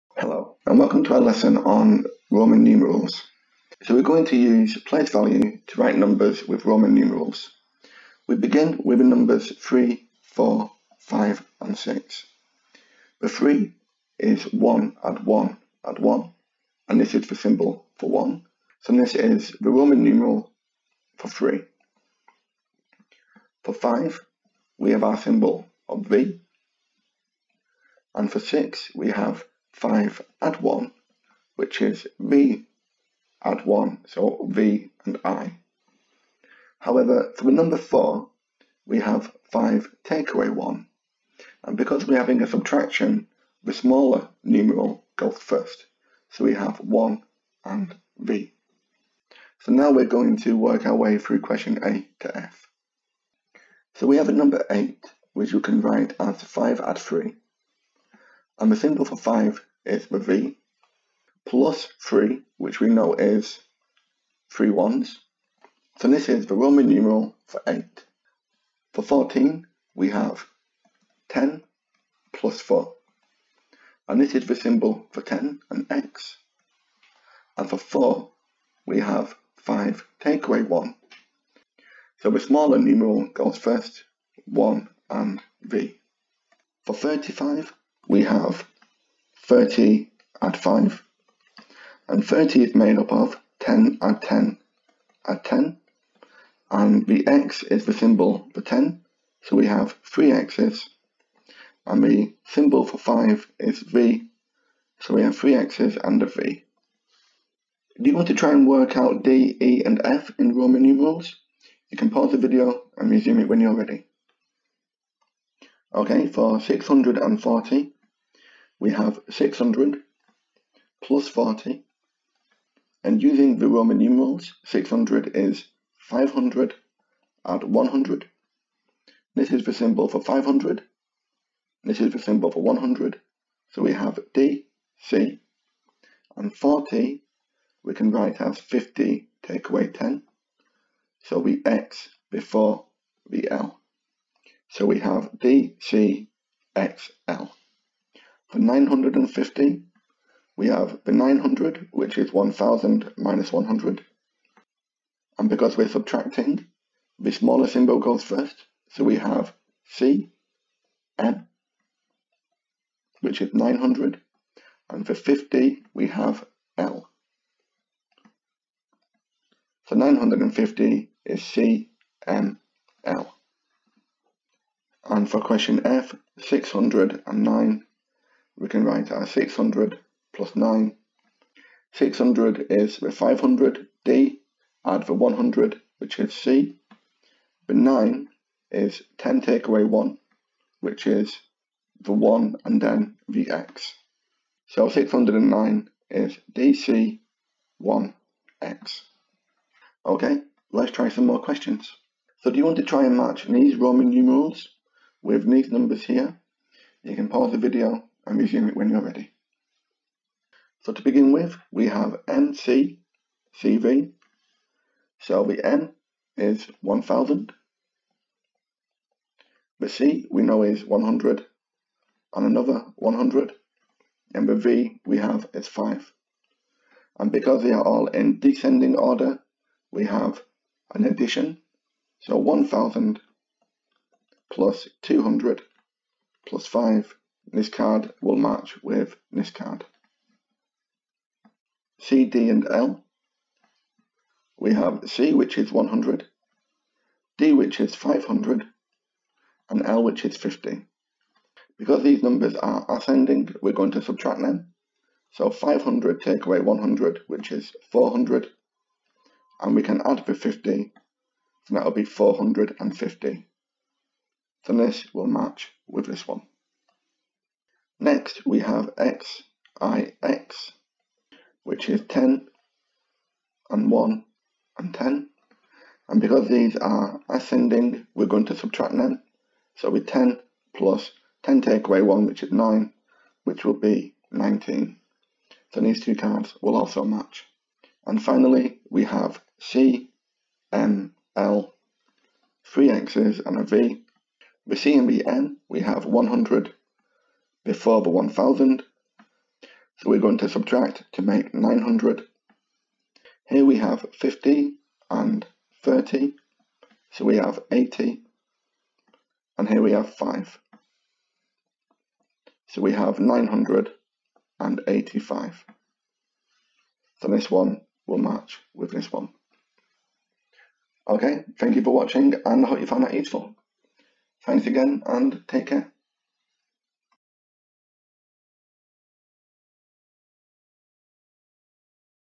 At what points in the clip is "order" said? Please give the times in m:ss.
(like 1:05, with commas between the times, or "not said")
3:48.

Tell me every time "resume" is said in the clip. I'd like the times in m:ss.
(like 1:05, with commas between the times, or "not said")
1:53, 3:28.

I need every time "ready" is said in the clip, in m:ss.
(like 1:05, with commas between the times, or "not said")
1:53, 3:29.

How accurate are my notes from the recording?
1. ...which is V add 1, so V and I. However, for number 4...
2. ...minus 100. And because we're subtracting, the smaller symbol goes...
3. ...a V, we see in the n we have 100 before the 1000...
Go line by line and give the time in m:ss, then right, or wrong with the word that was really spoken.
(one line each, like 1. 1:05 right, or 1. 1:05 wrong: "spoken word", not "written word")
1. 0:31 right
2. 2:33 right
3. 4:53 right.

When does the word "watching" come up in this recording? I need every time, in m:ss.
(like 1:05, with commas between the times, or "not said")
5:21.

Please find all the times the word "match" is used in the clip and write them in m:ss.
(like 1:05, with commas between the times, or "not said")
3:23, 3:58, 4:25, 4:47, 5:18.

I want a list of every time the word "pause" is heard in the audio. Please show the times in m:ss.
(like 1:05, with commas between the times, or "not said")
1:52, 3:27.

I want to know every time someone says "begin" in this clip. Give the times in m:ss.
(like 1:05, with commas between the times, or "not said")
0:08, 3:31.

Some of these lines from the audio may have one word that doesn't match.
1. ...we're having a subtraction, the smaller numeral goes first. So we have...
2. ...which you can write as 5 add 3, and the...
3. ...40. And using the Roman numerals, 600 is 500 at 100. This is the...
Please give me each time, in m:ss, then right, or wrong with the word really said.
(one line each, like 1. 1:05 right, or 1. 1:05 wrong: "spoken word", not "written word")
1. 0:42 right
2. 0:55 right
3. 2:01 right.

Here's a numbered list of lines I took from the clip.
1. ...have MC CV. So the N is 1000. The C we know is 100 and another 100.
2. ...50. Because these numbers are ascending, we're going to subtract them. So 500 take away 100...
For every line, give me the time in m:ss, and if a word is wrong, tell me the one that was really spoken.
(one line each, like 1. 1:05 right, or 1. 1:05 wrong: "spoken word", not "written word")
1. 3:31 right
2. 4:10 right.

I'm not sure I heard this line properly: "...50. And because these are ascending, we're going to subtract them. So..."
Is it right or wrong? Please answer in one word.
wrong.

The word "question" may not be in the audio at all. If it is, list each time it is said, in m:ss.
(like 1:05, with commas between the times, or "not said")
0:51, 2:55, 3:21.